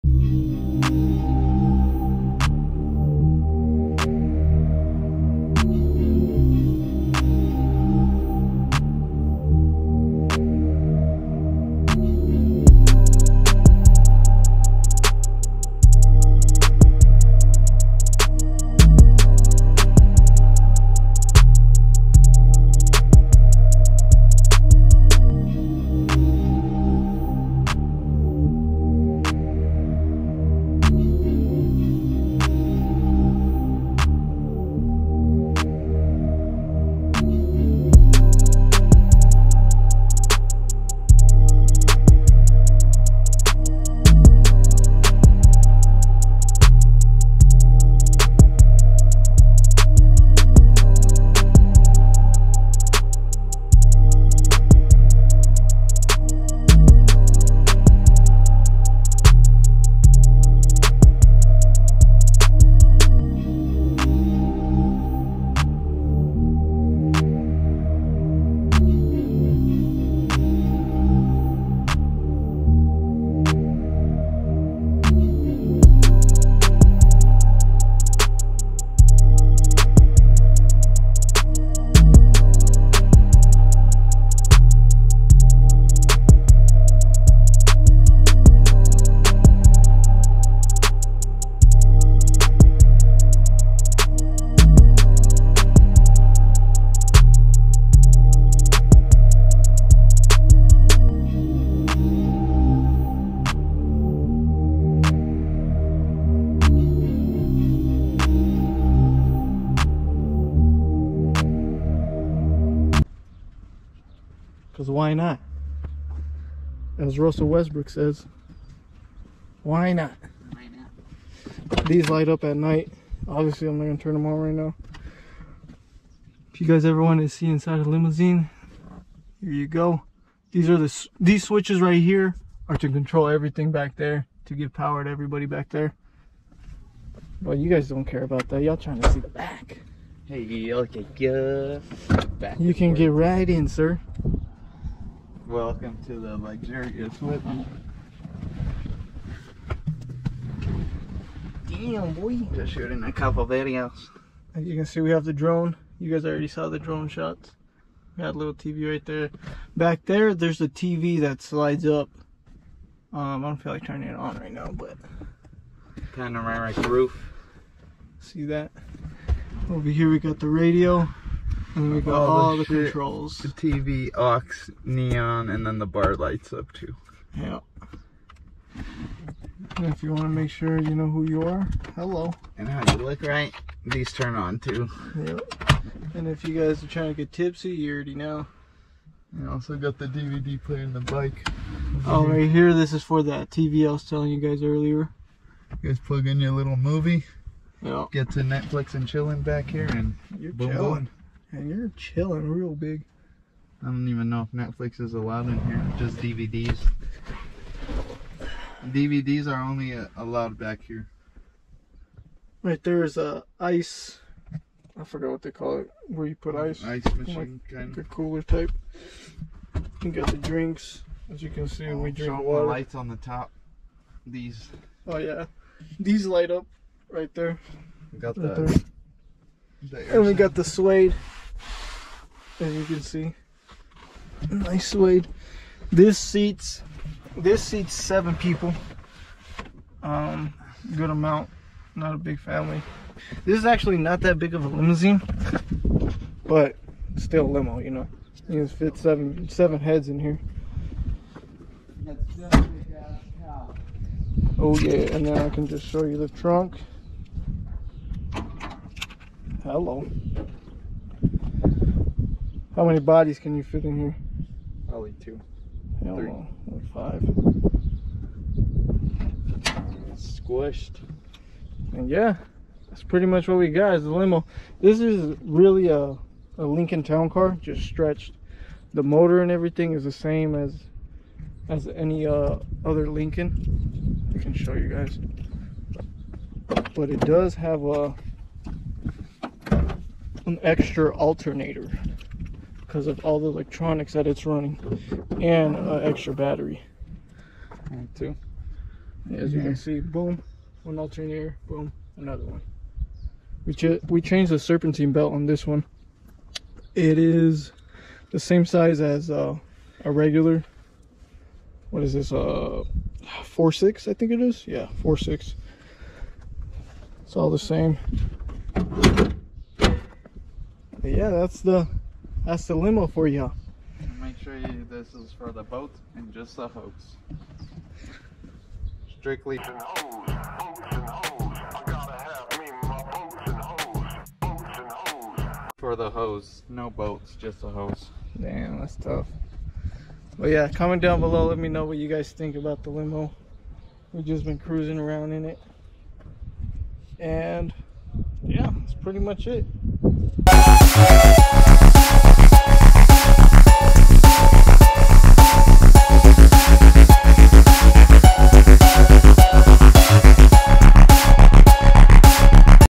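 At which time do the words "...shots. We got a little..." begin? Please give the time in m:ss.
2:37.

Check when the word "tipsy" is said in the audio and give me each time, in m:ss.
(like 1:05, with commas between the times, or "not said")
3:07.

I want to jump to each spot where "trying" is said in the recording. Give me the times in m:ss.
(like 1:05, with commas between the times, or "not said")
2:18, 3:06.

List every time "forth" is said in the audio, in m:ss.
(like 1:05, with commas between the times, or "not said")
2:22.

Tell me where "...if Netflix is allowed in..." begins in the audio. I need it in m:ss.
3:24.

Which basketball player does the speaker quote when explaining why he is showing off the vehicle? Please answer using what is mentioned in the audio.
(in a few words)
Russell Westbrook.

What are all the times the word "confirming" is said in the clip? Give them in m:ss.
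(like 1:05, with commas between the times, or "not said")
not said.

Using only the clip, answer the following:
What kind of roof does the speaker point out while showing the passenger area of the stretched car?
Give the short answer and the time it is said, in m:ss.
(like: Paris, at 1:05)
Panoramic, at 2:46.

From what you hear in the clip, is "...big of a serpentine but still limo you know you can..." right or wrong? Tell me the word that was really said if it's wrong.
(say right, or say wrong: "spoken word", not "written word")
wrong: "limousine", not "serpentine".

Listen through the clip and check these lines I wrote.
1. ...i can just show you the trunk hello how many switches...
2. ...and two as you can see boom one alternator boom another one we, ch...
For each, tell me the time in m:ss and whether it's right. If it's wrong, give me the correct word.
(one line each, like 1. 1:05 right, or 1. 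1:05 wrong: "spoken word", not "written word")
1. 4:15 wrong: "bodies", not "switches"
2. 4:57 right.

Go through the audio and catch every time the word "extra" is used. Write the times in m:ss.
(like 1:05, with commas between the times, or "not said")
4:50, 4:55.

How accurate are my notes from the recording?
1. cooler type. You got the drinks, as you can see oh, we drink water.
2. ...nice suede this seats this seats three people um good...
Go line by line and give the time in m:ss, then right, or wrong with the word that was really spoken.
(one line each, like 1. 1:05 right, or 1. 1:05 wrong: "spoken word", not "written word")
1. 3:38 right
2. 3:54 wrong: "seven", not "three".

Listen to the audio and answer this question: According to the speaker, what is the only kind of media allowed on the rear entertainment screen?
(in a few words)
DVDs.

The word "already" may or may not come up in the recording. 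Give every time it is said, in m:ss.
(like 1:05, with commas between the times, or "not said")
2:36, 3:07.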